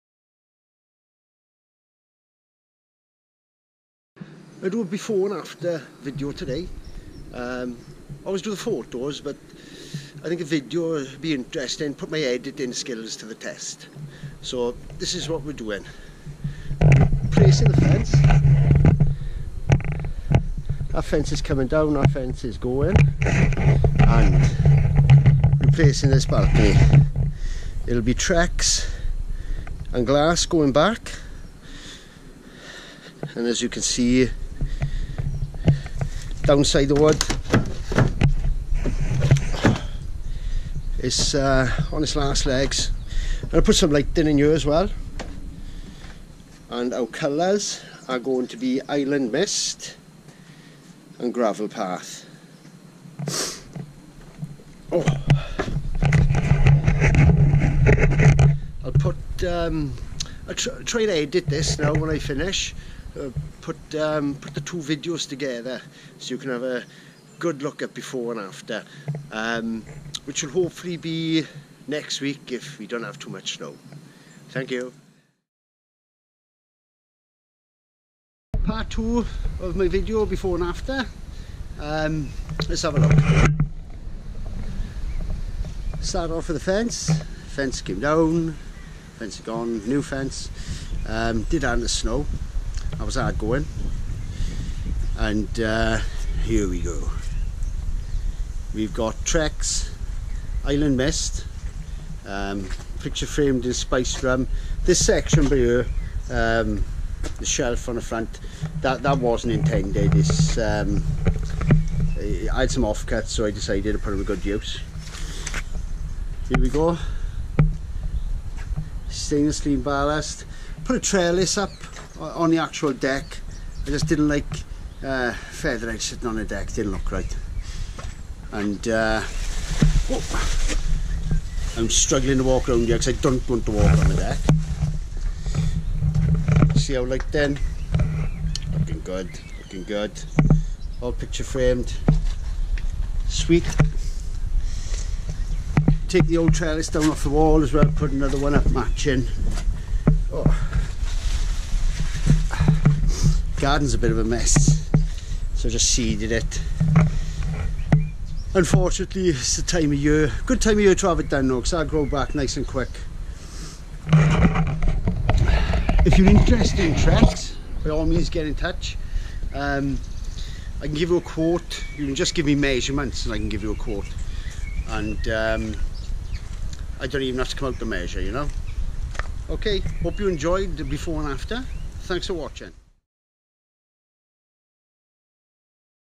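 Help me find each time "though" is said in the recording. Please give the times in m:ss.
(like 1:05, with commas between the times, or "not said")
2:41.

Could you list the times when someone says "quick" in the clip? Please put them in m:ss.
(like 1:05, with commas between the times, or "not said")
2:42.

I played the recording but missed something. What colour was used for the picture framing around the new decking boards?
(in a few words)
Spiced Rum.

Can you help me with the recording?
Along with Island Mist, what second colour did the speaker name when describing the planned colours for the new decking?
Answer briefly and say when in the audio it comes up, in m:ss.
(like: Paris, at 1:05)
Gravel Path, at 0:51.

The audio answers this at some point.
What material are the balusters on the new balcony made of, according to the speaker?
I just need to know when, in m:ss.
1:59.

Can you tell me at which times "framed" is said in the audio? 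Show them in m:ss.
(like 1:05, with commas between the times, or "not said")
1:43, 2:21.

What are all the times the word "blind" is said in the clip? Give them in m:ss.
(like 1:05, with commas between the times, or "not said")
not said.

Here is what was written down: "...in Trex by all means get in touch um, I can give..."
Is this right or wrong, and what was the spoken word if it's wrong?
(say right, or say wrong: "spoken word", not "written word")
right.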